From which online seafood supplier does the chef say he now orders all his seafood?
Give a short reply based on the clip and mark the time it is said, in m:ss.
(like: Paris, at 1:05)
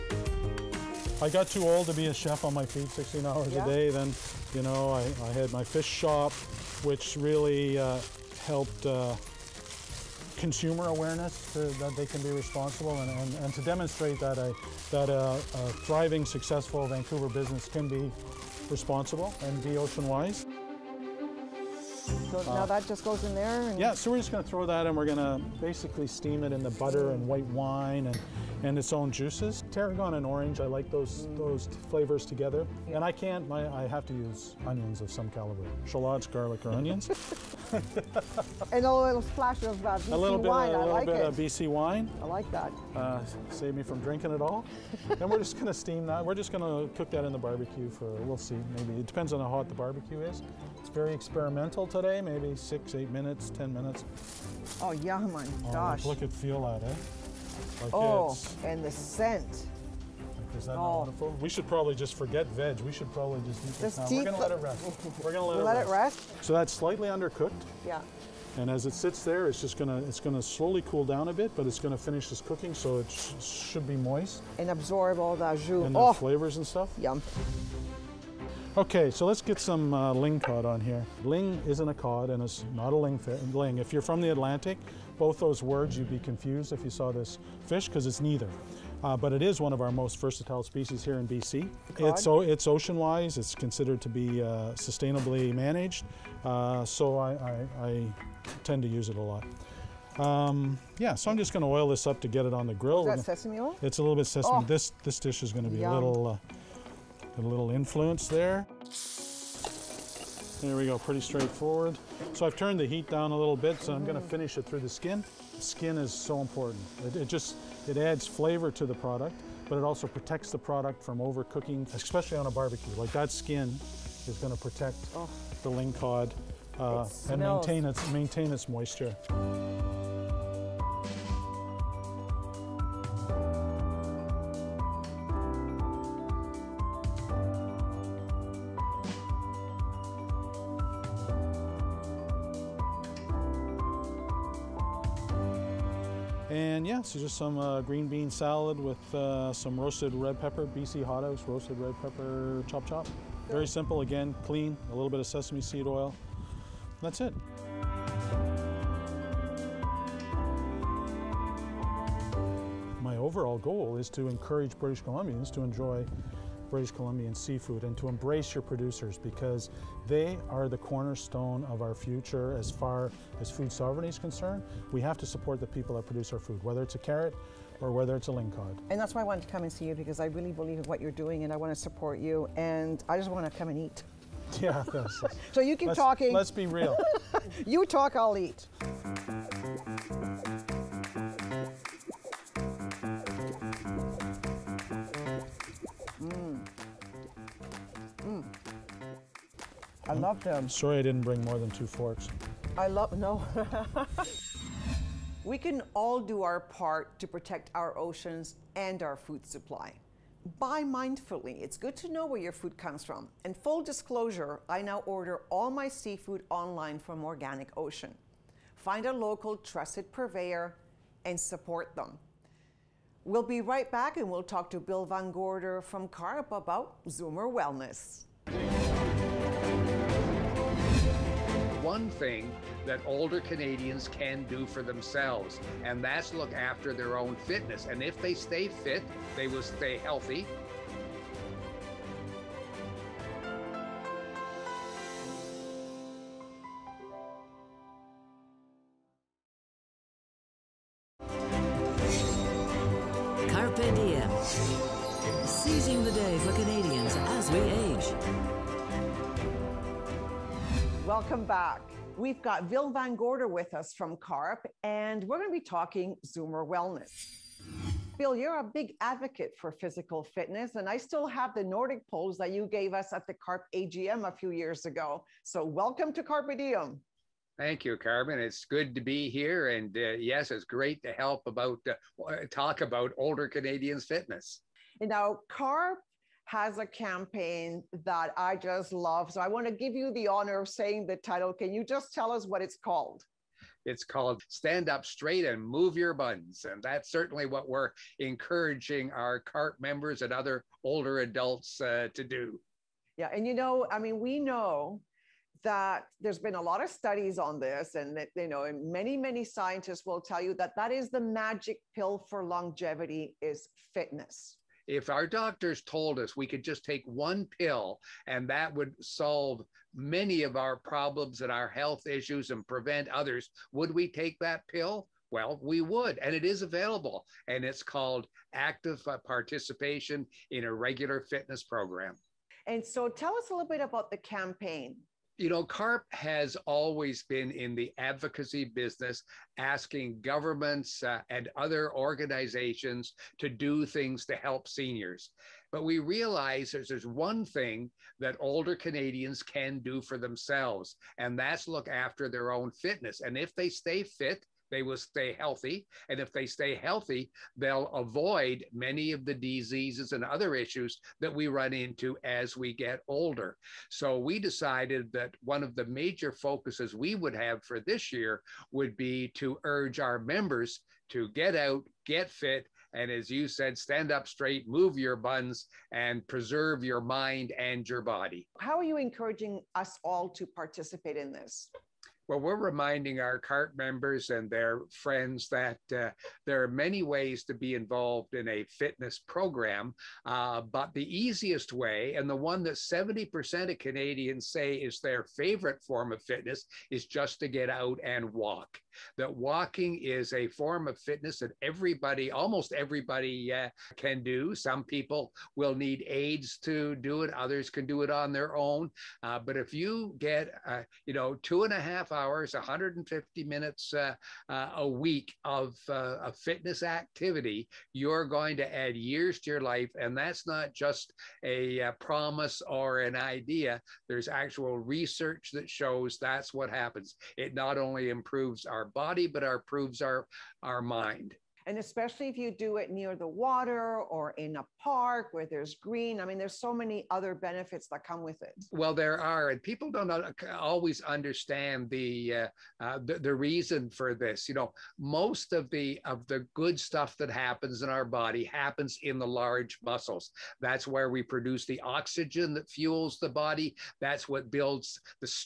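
Organic Ocean, at 3:37.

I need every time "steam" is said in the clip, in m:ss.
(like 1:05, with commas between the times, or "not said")
0:26, 0:45.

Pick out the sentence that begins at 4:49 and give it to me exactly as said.
So I want to give you the honor of saying the title.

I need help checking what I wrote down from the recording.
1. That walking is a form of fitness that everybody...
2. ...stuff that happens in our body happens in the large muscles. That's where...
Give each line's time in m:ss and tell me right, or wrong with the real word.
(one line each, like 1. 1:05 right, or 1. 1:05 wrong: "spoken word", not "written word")
1. 6:39 right
2. 7:26 right.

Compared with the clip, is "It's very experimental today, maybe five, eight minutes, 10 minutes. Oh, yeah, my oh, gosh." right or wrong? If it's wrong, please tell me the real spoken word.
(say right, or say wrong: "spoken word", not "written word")
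wrong: "six", not "five".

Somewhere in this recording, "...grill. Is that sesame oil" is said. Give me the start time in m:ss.
1:42.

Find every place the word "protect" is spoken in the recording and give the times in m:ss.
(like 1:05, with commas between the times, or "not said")
2:00, 2:04, 3:27.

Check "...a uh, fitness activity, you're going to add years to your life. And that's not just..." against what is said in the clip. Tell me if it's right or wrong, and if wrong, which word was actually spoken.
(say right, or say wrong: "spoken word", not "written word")
right.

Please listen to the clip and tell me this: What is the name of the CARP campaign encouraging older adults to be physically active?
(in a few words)
Stand Up Straight and Move Your Buns.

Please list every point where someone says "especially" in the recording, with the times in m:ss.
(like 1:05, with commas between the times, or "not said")
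2:01, 7:11.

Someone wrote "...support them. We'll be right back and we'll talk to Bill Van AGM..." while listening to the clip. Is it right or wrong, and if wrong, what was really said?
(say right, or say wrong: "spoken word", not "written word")
wrong: "Gorder", not "AGM".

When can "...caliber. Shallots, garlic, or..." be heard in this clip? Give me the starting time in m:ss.
0:35.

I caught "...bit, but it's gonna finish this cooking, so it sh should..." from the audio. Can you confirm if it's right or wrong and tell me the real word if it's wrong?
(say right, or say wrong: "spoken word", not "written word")
right.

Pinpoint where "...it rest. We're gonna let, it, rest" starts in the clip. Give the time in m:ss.
1:04.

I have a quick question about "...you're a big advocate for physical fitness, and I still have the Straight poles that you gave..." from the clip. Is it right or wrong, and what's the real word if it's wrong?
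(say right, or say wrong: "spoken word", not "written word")
wrong: "Nordic", not "Straight".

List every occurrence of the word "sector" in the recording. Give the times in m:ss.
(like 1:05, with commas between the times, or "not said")
not said.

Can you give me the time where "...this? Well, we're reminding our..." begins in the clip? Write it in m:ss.
6:21.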